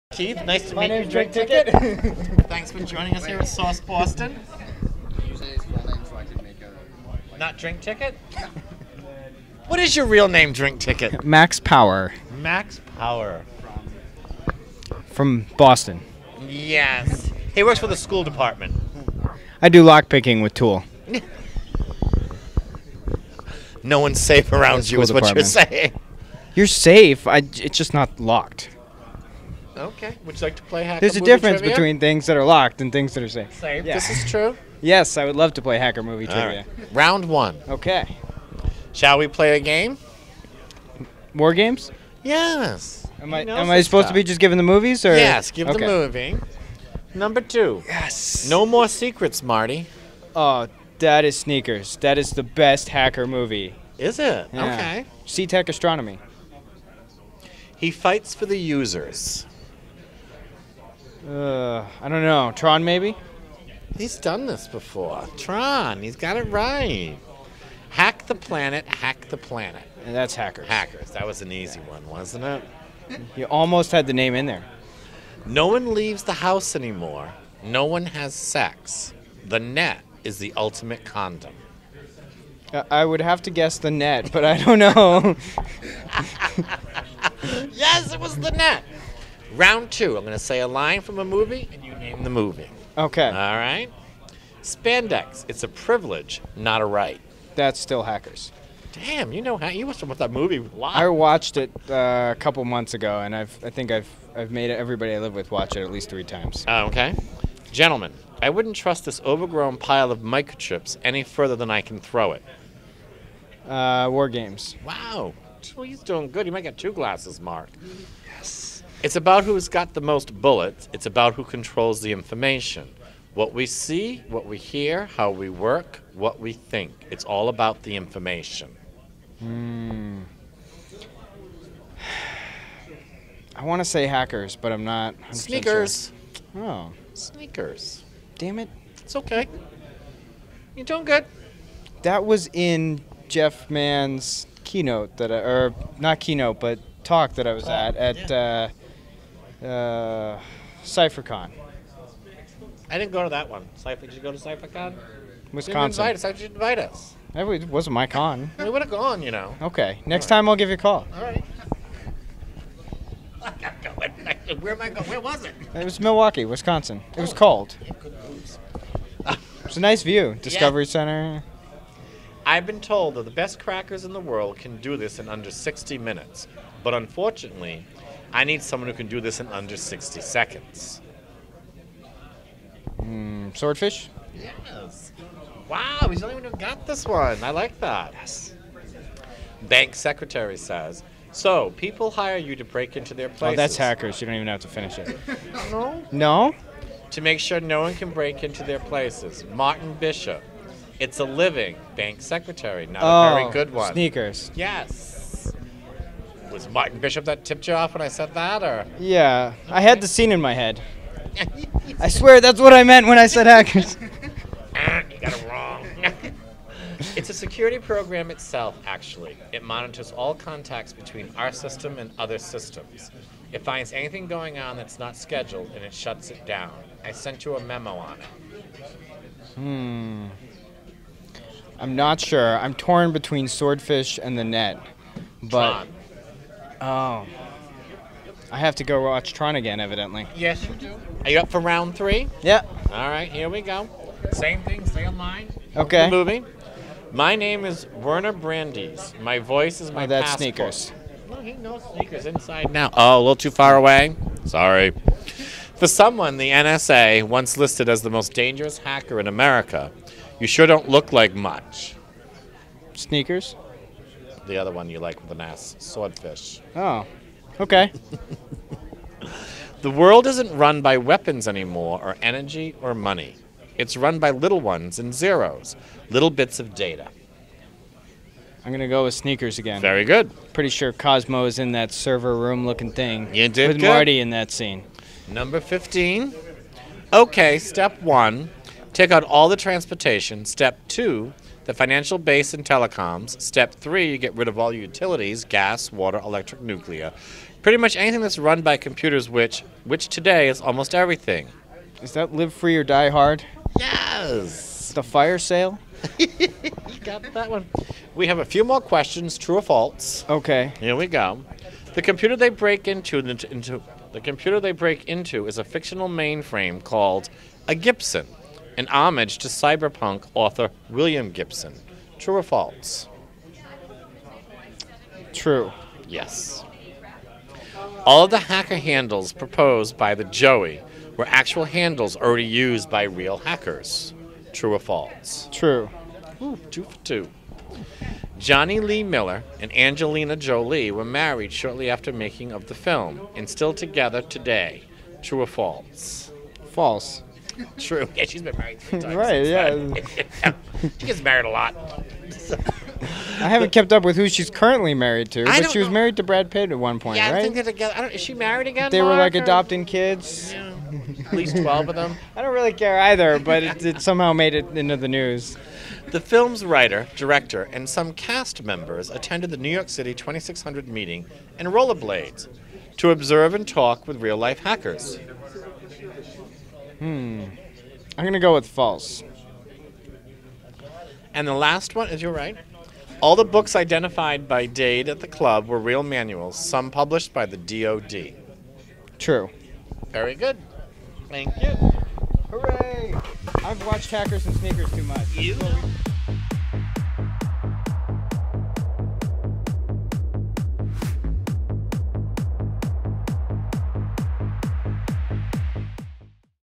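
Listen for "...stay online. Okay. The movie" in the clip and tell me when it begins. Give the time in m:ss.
4:04.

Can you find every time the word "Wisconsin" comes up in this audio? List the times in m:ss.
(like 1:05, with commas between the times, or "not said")
2:35, 2:46.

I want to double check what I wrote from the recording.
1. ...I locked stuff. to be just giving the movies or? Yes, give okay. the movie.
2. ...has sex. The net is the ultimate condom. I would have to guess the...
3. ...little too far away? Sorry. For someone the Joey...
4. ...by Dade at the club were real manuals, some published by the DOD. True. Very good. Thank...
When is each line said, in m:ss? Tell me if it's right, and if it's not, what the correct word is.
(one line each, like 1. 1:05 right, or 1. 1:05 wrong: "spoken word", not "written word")
1. 0:43 wrong: "supposed", not "locked"
2. 1:18 right
3. 4:13 wrong: "NSA", not "Joey"
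4. 6:24 right.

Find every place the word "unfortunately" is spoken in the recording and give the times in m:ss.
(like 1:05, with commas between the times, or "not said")
2:56.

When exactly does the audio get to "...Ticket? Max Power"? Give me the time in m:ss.
0:10.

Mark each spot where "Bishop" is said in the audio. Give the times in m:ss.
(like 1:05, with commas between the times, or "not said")
3:19, 3:26.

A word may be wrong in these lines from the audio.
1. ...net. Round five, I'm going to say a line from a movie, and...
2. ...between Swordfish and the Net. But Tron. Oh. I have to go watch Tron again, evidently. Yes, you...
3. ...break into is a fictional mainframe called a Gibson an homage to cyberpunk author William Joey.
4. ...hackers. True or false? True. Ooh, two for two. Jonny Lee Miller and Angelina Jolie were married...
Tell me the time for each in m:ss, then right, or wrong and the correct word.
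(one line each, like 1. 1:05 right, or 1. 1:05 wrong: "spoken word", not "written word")
1. 1:28 wrong: "two", not "five"
2. 3:53 right
3. 5:14 wrong: "Gibson", not "Joey"
4. 5:33 right.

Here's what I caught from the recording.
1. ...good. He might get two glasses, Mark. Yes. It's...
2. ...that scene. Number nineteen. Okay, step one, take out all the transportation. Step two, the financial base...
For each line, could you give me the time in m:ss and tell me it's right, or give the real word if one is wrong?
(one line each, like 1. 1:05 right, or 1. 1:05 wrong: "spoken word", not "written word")
1. 1:56 right
2. 4:44 wrong: "fifteen", not "nineteen".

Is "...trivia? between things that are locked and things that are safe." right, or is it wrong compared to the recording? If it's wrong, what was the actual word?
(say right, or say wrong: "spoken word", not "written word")
right.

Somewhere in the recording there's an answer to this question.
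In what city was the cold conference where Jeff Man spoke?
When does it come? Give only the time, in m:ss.
2:45.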